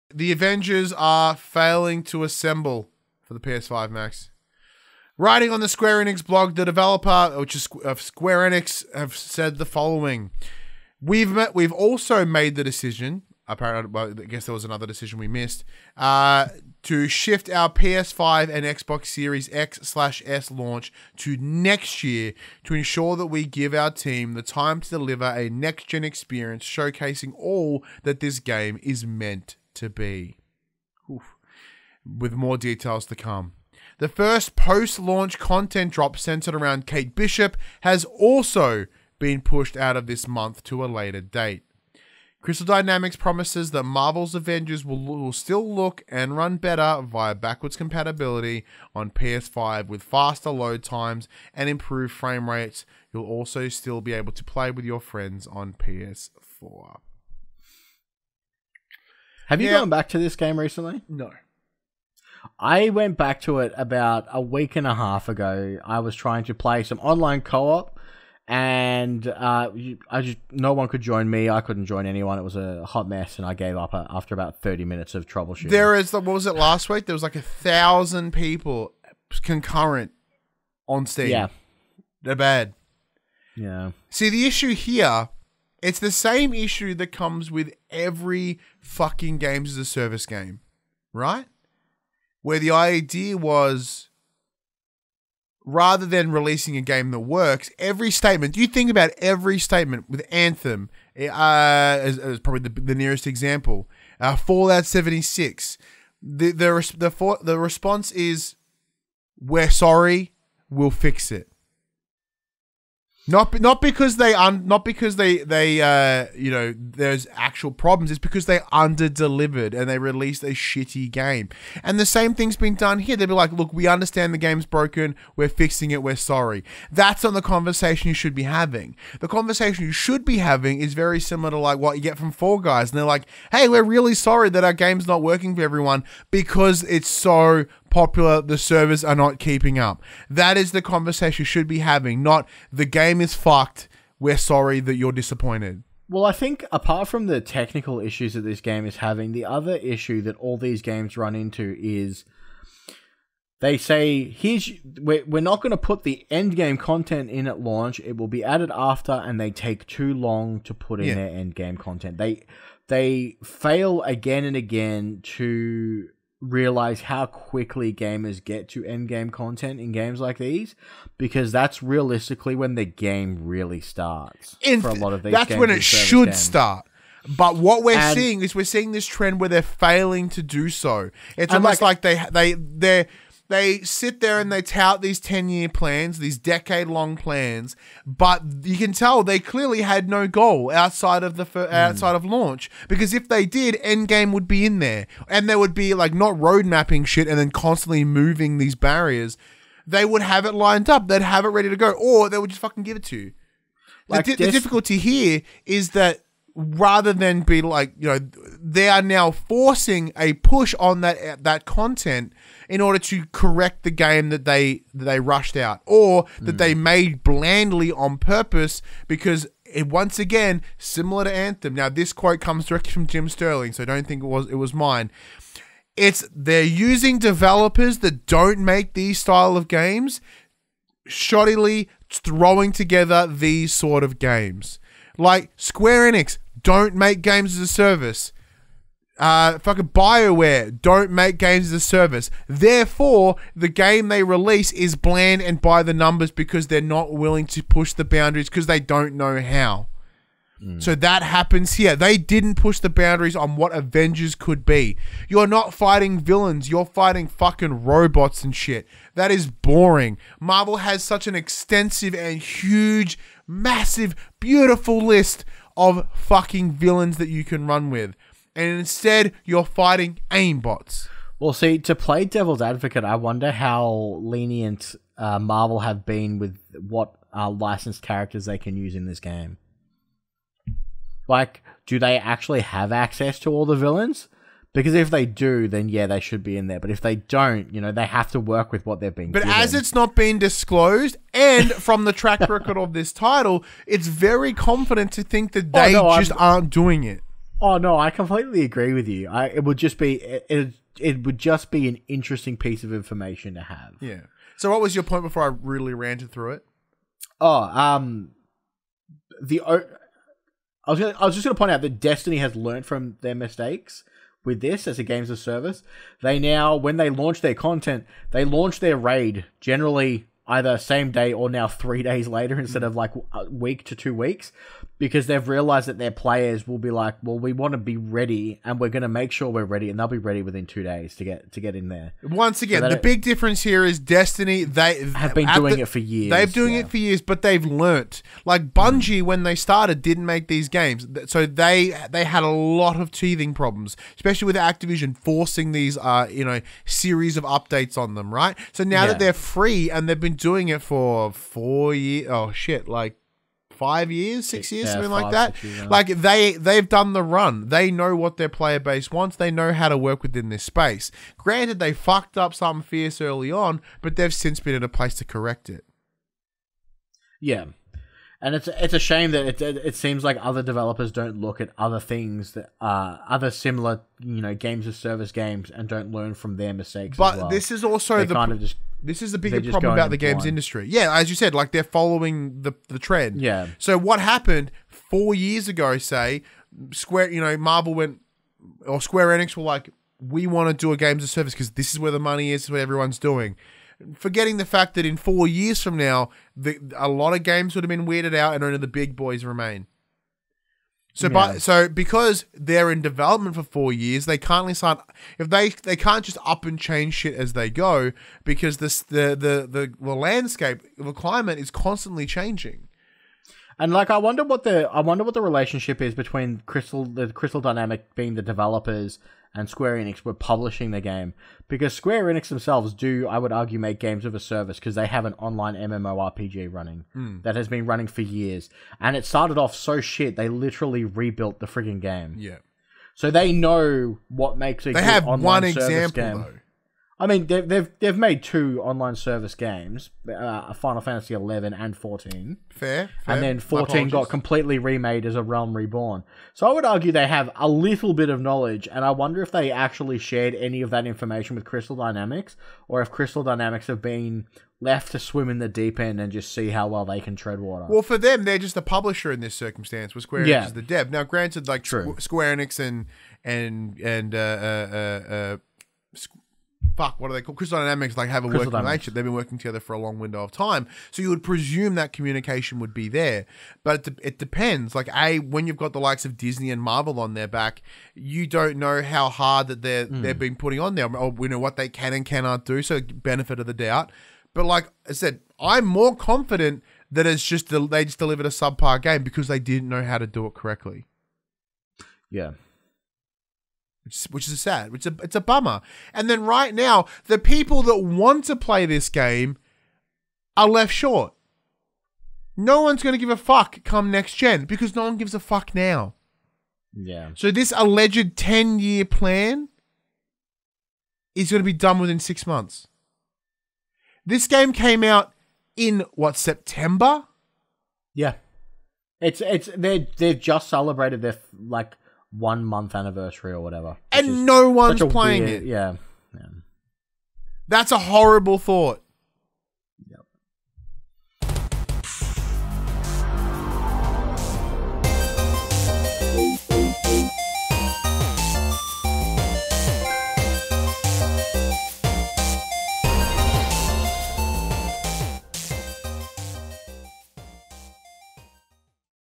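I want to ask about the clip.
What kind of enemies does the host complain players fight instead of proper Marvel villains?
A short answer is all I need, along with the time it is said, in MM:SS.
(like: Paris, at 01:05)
AIM bots, at 04:30.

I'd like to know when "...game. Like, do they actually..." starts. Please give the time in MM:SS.
04:39.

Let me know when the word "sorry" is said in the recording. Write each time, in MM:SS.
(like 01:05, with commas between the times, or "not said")
01:49, 02:06, 02:14, 02:24.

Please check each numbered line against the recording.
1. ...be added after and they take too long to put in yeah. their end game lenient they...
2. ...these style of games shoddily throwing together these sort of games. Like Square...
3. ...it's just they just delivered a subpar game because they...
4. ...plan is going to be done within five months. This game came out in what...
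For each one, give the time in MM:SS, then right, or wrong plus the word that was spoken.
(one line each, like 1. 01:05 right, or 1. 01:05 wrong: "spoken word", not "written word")
1. 02:38 wrong: "content", not "lenient"
2. 03:48 right
3. 08:07 right
4. 08:29 wrong: "six", not "five".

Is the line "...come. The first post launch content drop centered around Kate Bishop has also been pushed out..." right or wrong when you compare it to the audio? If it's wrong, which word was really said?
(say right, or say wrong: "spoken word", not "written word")
right.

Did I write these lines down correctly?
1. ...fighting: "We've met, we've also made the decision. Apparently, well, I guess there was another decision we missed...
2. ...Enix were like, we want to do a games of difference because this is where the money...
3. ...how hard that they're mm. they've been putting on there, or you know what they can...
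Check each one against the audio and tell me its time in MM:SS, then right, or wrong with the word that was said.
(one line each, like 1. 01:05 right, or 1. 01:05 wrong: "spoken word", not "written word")
1. 00:09 wrong: "following", not "fighting"
2. 06:29 wrong: "service", not "difference"
3. 07:59 right.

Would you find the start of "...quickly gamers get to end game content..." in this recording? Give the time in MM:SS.
02:47.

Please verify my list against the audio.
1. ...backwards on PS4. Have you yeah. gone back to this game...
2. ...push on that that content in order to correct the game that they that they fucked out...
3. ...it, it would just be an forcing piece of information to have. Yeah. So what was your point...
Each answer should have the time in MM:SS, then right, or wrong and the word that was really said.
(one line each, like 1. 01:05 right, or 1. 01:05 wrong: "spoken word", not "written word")
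1. 00:54 wrong: "friends", not "backwards"
2. 03:30 wrong: "rushed", not "fucked"
3. 05:00 wrong: "interesting", not "forcing".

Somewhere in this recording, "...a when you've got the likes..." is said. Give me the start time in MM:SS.
07:55.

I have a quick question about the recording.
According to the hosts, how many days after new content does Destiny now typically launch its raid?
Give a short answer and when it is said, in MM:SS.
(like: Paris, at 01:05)
3, at 05:21.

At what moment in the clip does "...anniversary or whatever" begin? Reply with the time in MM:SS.
08:42.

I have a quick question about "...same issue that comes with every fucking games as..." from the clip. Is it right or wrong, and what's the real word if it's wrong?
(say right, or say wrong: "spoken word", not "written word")
right.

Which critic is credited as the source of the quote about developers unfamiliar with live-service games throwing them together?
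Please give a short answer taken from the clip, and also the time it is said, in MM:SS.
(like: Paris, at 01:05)
Jim Sterling, at 03:43.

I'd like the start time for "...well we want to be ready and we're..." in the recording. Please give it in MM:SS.
05:27.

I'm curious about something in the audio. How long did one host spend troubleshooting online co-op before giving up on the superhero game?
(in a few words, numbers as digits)
30 minutes.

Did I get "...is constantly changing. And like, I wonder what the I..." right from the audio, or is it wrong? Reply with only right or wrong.
right.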